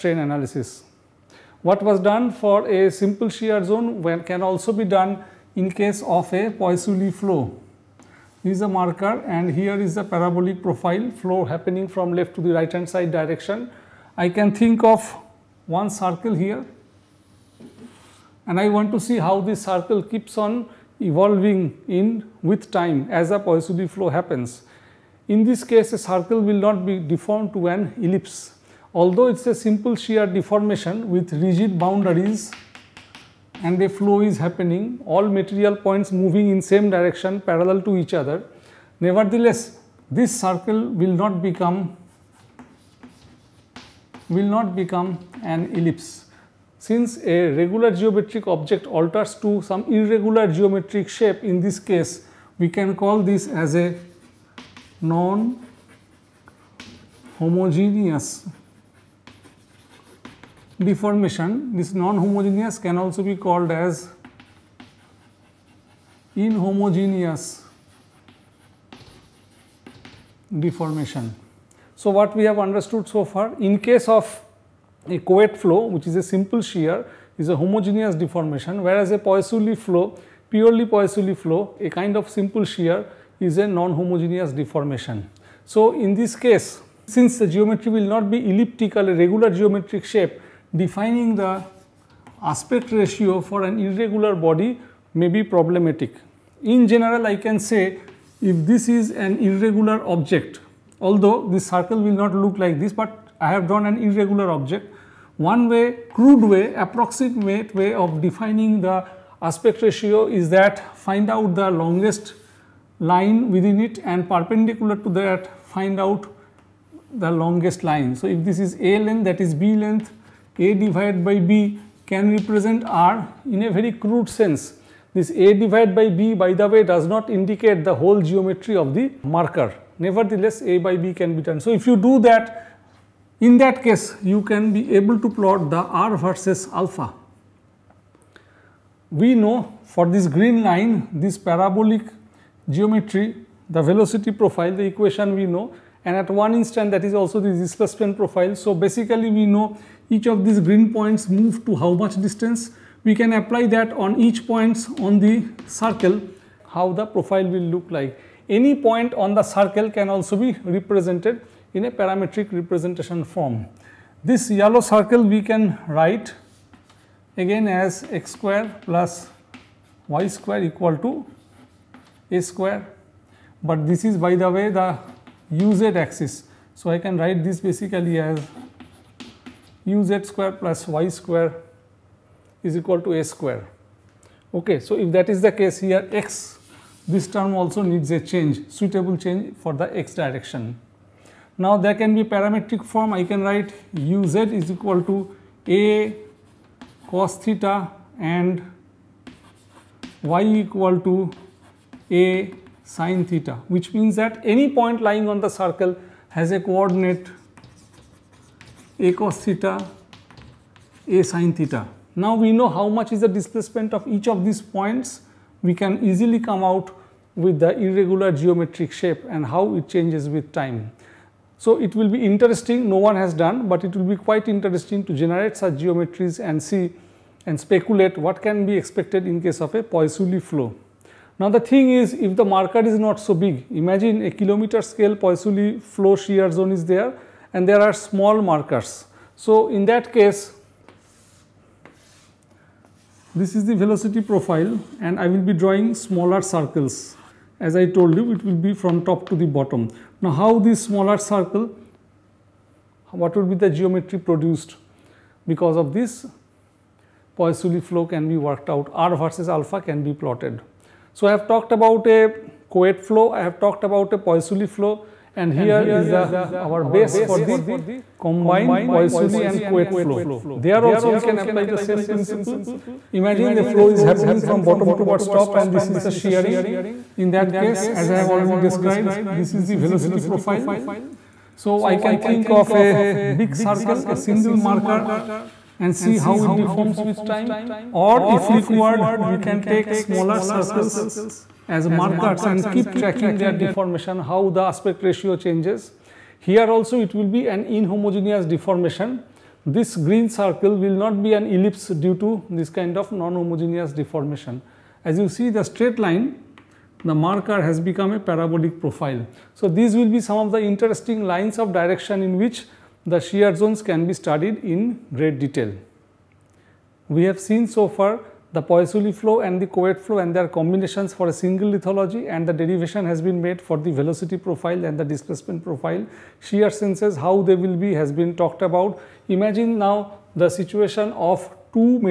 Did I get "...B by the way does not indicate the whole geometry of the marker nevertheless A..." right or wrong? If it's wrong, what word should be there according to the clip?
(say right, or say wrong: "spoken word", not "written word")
right.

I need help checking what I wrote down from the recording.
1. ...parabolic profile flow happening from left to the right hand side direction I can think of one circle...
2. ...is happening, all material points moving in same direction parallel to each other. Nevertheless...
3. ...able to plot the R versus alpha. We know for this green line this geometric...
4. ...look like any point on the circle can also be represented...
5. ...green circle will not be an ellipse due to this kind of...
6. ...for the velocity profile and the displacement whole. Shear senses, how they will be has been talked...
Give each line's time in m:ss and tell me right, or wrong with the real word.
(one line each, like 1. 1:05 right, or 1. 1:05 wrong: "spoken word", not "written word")
1. 0:10 right
2. 0:34 right
3. 2:14 wrong: "parabolic", not "geometric"
4. 2:37 right
5. 4:59 right
6. 5:23 wrong: "profile", not "whole".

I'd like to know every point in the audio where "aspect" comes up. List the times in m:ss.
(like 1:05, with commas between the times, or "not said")
1:32, 1:49, 4:54.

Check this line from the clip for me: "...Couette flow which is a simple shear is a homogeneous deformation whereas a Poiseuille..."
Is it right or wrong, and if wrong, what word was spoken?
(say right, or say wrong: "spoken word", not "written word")
right.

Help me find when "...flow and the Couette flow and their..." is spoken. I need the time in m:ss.
5:19.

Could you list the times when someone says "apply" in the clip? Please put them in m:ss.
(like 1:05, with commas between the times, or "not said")
2:33, 4:31.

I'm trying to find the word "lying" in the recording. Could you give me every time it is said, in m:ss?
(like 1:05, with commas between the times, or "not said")
3:24.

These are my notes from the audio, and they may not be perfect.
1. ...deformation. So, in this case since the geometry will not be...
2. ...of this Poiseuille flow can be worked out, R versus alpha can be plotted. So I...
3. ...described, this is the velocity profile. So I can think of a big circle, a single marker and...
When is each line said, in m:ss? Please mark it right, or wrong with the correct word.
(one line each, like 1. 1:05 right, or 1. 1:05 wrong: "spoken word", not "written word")
1. 1:24 right
2. 4:15 right
3. 4:38 right.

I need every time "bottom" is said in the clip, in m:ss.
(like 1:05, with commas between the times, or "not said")
4:09, 4:34.